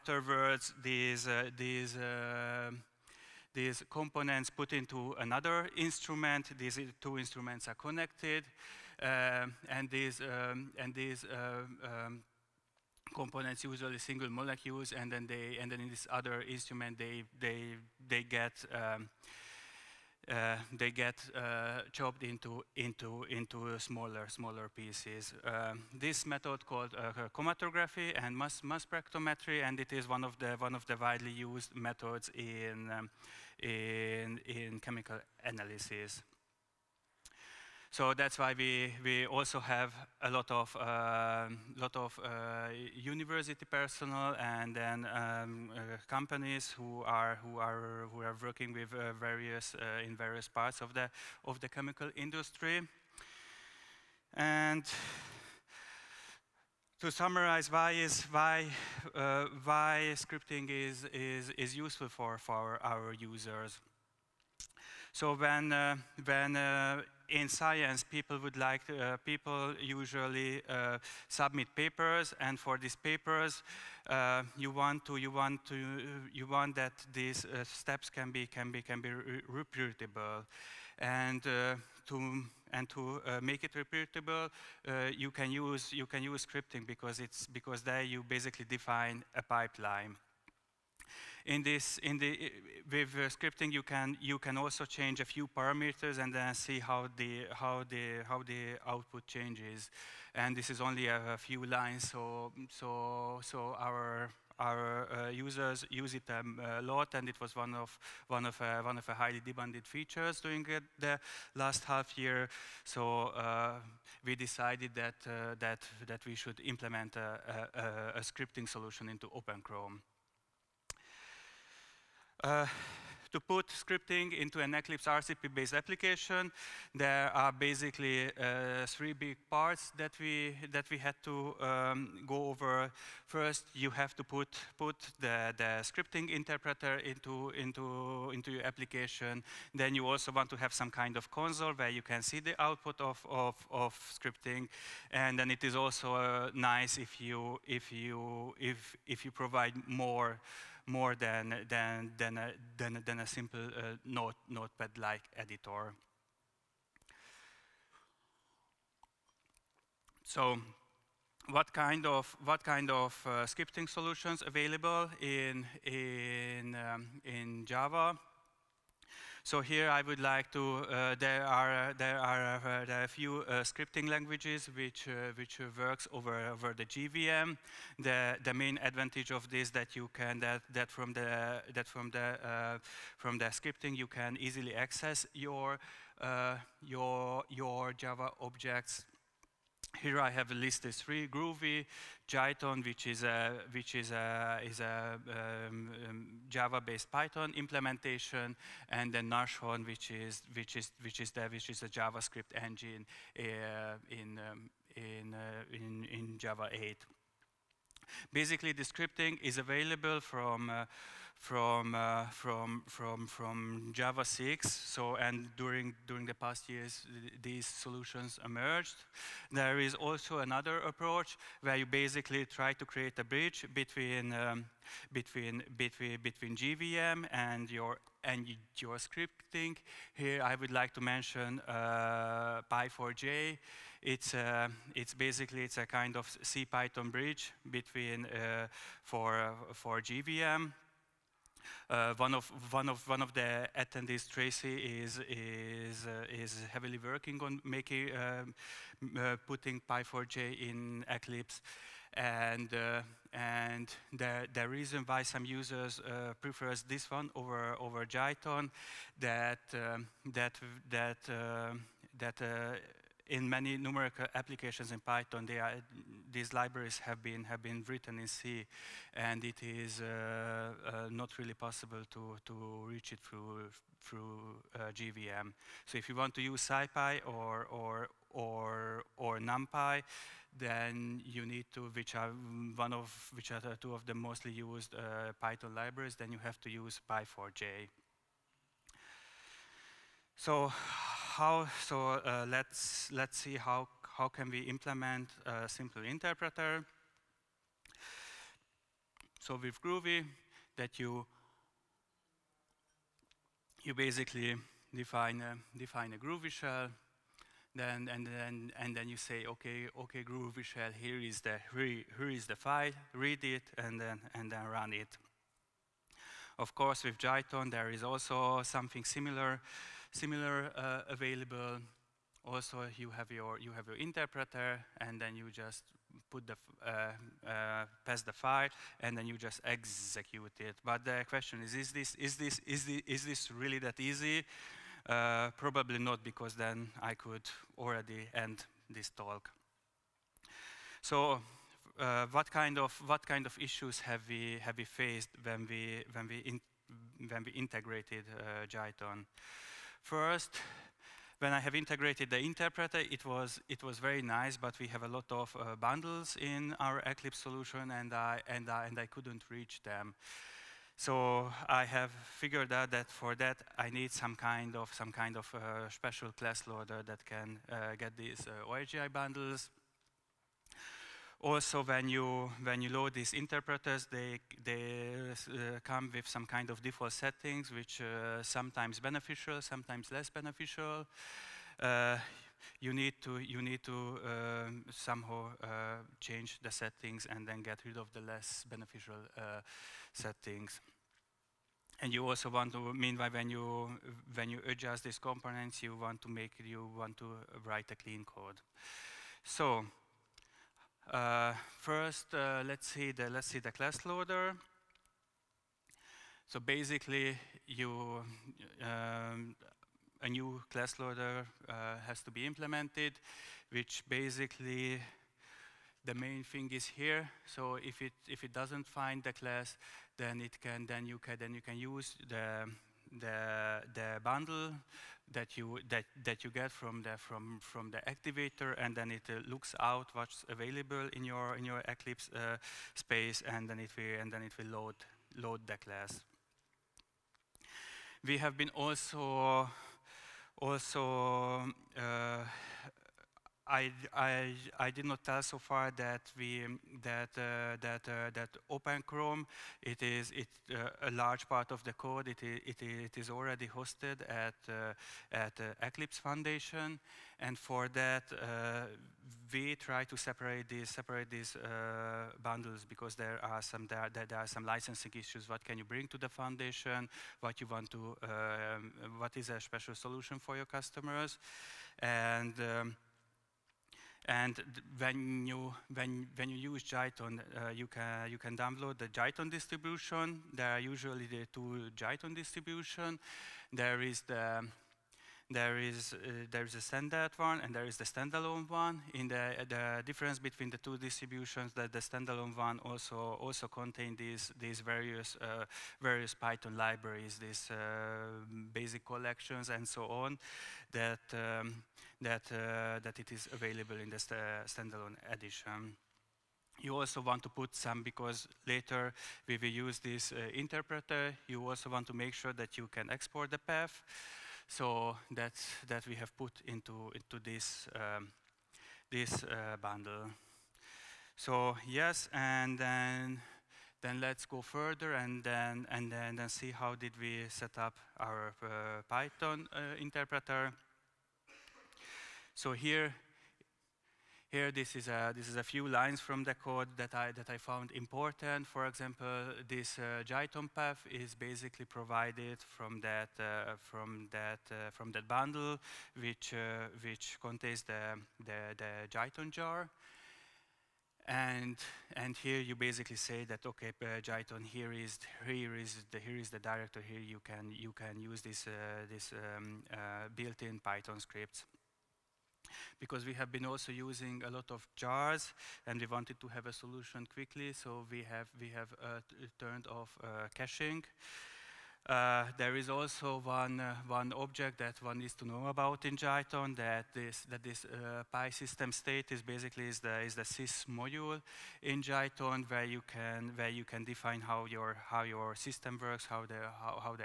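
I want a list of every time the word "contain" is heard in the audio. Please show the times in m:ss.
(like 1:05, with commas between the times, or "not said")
8:13, 9:07.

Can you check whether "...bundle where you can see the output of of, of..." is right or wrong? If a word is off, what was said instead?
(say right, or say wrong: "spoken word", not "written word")
wrong: "console", not "bundle".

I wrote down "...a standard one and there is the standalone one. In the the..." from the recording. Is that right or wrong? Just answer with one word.
right.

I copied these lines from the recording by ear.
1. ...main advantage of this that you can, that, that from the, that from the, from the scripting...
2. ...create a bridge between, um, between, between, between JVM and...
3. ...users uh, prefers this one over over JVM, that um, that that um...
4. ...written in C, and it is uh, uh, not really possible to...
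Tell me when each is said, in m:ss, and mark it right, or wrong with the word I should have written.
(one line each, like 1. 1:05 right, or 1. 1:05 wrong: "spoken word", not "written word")
1. 2:58 right
2. 3:42 right
3. 4:15 wrong: "Jython", not "JVM"
4. 4:27 right.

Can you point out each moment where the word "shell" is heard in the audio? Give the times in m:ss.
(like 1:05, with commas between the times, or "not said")
5:06, 5:10.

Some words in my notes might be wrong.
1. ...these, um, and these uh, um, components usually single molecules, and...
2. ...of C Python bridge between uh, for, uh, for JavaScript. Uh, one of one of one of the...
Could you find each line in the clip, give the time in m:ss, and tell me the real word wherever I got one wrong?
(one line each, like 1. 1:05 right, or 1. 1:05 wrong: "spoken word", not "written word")
1. 0:09 right
2. 3:56 wrong: "JVM", not "JavaScript".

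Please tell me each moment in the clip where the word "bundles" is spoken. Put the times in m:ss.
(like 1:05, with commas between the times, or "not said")
5:55, 6:09, 7:04, 7:42, 8:39, 9:05.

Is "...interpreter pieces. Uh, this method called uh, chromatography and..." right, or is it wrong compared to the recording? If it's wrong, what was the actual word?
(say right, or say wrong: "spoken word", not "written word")
wrong: "smaller", not "interpreter".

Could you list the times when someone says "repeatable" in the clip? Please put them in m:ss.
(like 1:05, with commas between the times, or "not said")
1:23.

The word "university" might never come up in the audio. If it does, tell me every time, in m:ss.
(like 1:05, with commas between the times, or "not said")
0:42.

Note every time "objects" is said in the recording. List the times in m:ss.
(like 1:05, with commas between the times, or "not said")
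3:08, 9:34.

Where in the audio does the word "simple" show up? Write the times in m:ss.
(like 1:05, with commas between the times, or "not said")
2:33, 4:55.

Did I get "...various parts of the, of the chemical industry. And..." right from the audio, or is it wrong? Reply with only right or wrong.
right.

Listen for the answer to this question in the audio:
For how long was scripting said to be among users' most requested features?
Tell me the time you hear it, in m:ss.
1:51.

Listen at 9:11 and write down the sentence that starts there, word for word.
And, and here you basically say that okay, uh, Jython, here is here is the here is the director.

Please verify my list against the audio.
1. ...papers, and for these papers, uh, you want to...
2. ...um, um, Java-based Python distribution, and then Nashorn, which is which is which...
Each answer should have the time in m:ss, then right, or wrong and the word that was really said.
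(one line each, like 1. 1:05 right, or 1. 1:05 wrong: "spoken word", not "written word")
1. 1:11 right
2. 3:15 wrong: "implementation", not "distribution".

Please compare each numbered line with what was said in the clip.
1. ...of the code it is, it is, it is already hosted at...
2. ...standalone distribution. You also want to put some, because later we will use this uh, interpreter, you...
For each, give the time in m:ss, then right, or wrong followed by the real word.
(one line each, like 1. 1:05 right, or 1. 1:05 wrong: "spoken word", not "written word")
1. 7:31 right
2. 8:24 wrong: "edition", not "distribution".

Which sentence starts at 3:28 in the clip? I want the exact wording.
Basically, the scripting is available from uh, from, uh, from, from, from Java 6.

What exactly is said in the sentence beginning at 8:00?
There are usually the two Jython distribution.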